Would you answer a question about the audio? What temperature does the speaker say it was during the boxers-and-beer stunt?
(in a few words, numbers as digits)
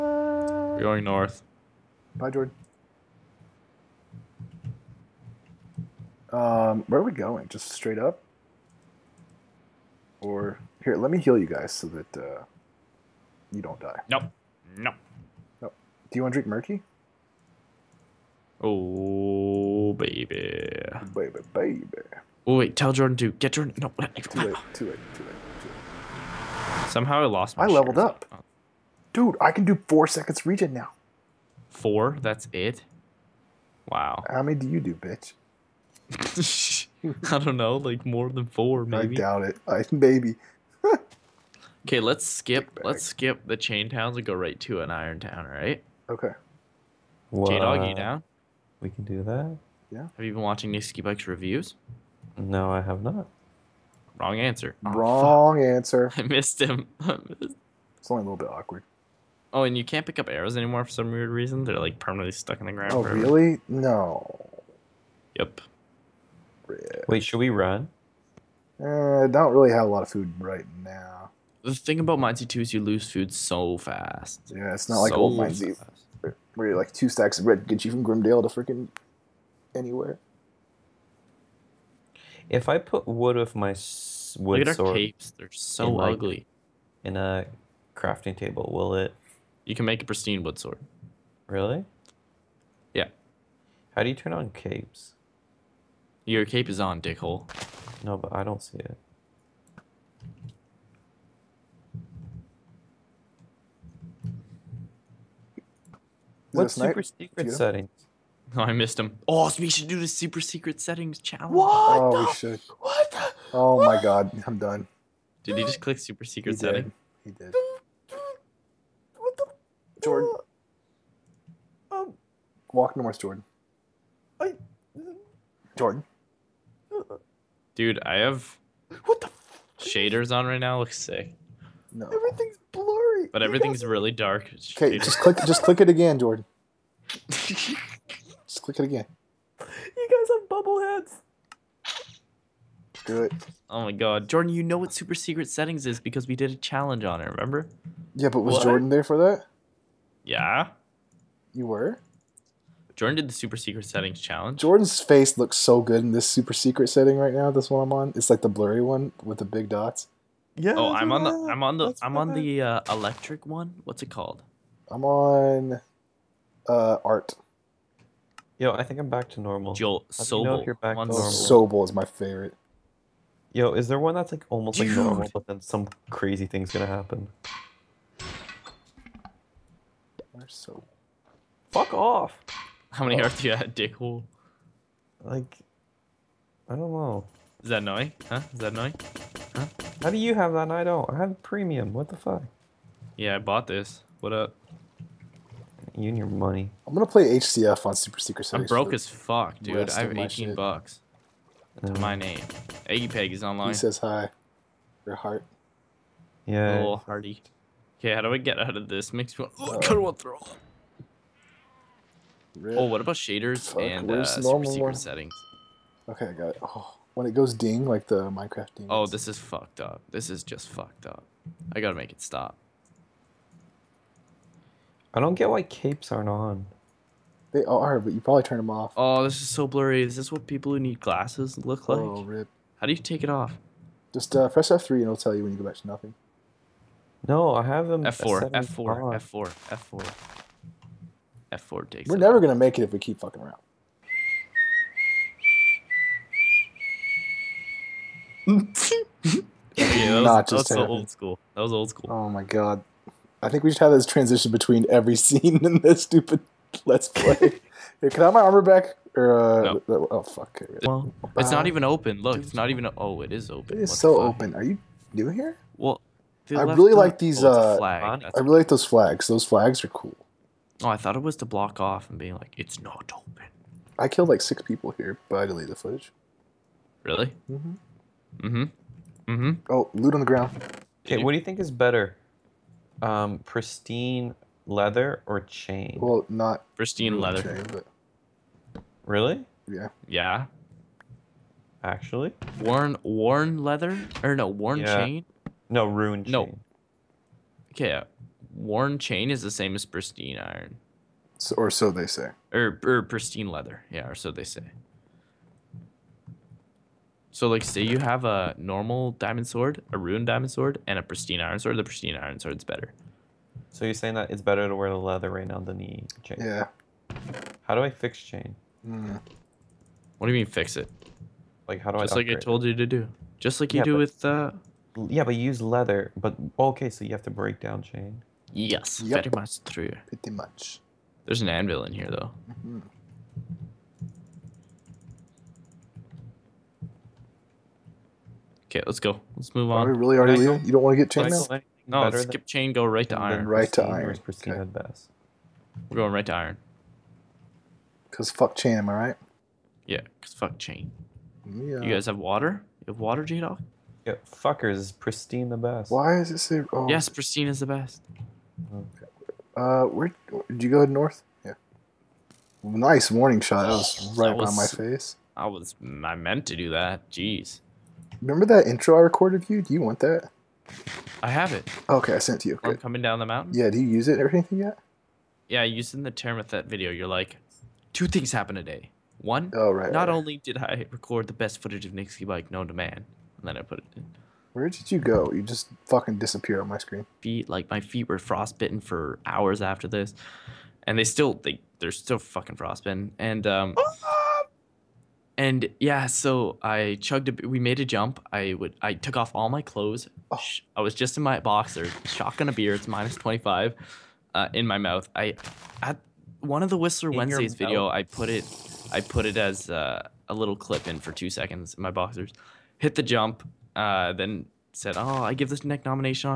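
Minus 25.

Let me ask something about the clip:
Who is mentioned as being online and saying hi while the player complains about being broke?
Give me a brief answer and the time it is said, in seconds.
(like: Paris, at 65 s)
Eggy Peg, at 202 s.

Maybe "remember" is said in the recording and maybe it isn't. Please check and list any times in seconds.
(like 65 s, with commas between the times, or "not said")
147 s, 368 s.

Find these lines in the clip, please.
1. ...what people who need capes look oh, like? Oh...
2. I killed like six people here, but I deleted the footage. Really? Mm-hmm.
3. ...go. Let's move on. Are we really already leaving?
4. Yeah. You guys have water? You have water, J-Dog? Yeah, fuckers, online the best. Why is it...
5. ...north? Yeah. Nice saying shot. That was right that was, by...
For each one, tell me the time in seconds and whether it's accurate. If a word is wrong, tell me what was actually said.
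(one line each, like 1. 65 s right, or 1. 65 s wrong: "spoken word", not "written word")
1. 230 s wrong: "glasses", not "capes"
2. 273 s right
3. 338 s right
4. 351 s wrong: "pristine", not "online"
5. 360 s wrong: "warning", not "saying".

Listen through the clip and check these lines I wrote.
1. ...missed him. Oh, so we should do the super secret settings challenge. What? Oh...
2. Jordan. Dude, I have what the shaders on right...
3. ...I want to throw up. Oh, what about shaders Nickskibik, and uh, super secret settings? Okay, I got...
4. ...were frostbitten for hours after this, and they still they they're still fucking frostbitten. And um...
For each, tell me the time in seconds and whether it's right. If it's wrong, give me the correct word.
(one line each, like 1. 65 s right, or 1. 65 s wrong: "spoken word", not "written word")
1. 108 s right
2. 125 s right
3. 209 s wrong: "Fuck", not "Nickskibik"
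4. 388 s right.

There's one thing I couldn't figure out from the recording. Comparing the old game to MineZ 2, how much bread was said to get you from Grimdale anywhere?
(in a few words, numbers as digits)
2 stacks.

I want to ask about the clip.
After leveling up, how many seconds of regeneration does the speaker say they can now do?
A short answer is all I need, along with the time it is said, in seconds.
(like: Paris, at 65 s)
4, at 29 s.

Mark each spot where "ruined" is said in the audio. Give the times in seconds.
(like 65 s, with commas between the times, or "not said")
295 s, 309 s.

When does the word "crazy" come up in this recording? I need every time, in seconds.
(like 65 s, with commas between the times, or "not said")
176 s.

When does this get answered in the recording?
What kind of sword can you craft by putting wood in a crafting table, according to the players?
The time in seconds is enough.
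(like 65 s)
90 s.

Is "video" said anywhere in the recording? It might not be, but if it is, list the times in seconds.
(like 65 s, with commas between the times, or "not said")
376 s, 407 s.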